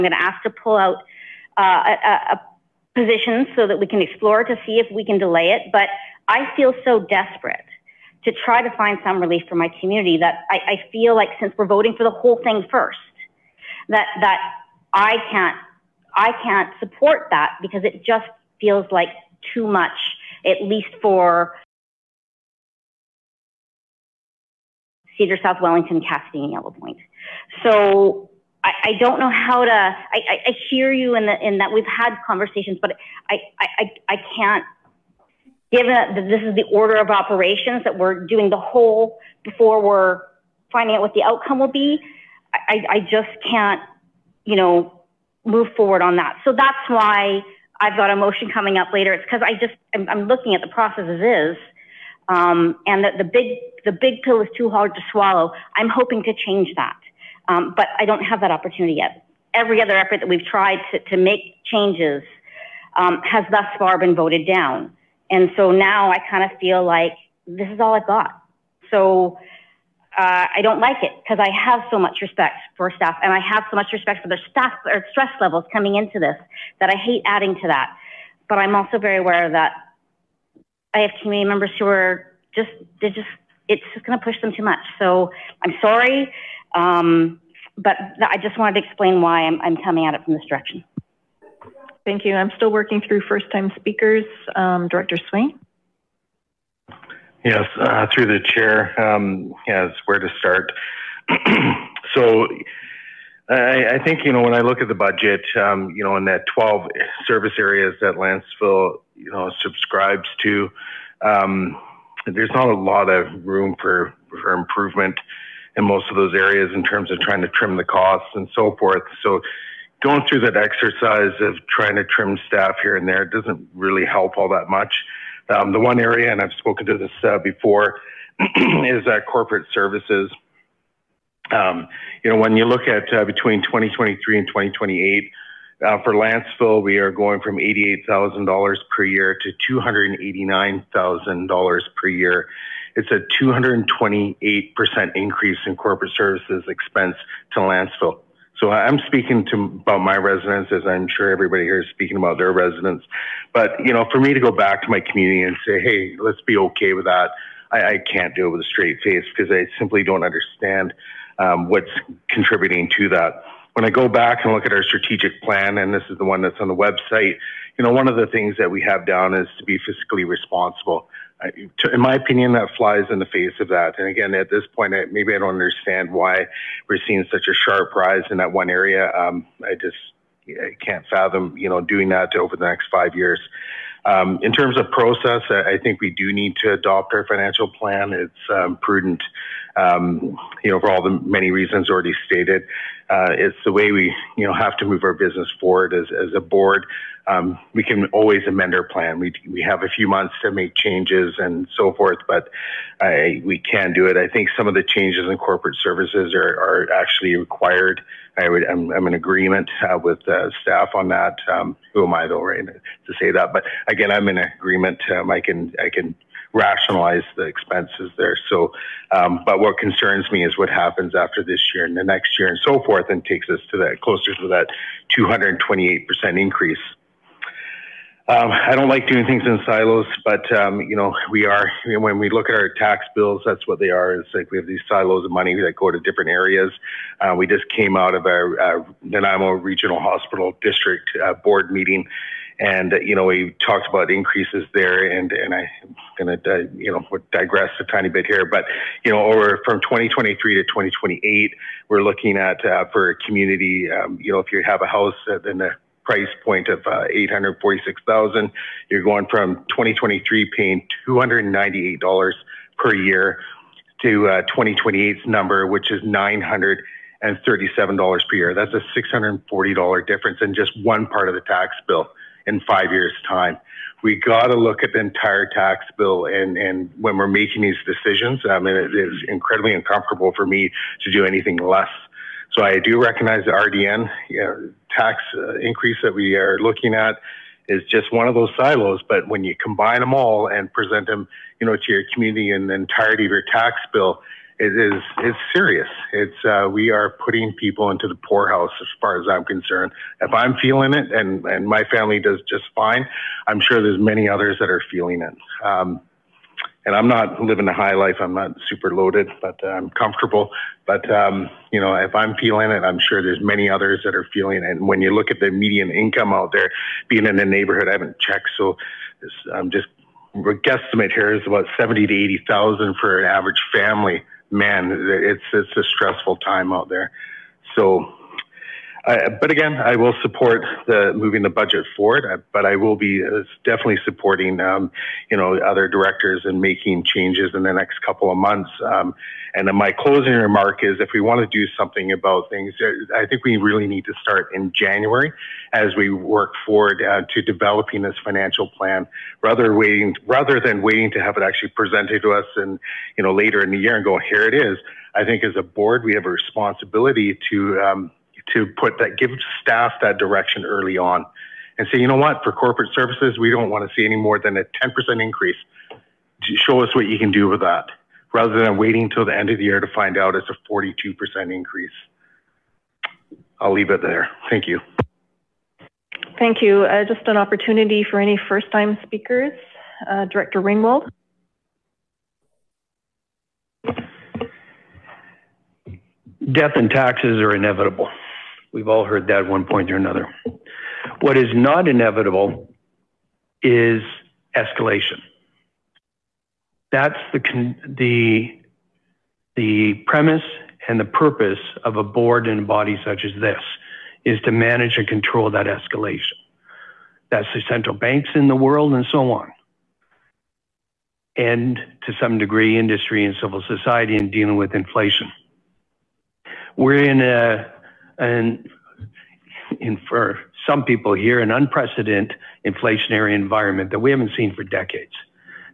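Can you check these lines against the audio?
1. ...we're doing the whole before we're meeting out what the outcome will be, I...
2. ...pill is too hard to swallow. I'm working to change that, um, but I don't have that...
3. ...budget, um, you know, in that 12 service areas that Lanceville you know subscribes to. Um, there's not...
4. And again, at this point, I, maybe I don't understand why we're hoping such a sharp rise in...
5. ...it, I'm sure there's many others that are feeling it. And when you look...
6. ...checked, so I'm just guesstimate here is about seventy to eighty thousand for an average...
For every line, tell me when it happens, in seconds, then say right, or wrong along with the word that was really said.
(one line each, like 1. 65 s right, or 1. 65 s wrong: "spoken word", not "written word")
1. 37 s wrong: "finding", not "meeting"
2. 54 s wrong: "hoping", not "working"
3. 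104 s right
4. 173 s wrong: "seeing", not "hoping"
5. 312 s right
6. 318 s right.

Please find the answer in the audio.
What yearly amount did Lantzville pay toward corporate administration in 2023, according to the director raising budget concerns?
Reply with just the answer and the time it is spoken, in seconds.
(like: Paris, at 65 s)
$88,000, at 137 s.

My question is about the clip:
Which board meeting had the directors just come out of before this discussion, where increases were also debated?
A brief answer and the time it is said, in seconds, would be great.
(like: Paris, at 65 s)
Nanaimo Regional Hospital District, at 239 s.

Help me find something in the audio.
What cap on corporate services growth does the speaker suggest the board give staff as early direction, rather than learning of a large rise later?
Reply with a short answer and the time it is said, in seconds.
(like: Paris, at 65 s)
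10%, at 364 s.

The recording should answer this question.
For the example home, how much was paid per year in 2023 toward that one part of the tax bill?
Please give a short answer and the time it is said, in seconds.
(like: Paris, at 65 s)
$298, at 261 s.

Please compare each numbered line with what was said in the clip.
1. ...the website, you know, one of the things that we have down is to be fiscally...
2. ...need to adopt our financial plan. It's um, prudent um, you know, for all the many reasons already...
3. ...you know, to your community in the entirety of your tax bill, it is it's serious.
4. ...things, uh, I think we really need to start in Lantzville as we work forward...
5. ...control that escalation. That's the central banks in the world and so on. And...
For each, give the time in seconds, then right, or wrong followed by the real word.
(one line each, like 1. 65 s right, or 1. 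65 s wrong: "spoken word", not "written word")
1. 166 s right
2. 186 s right
3. 291 s right
4. 342 s wrong: "January", not "Lantzville"
5. 405 s right.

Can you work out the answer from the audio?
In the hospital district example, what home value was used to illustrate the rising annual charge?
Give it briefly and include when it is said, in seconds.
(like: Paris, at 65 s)
$846,000, at 257 s.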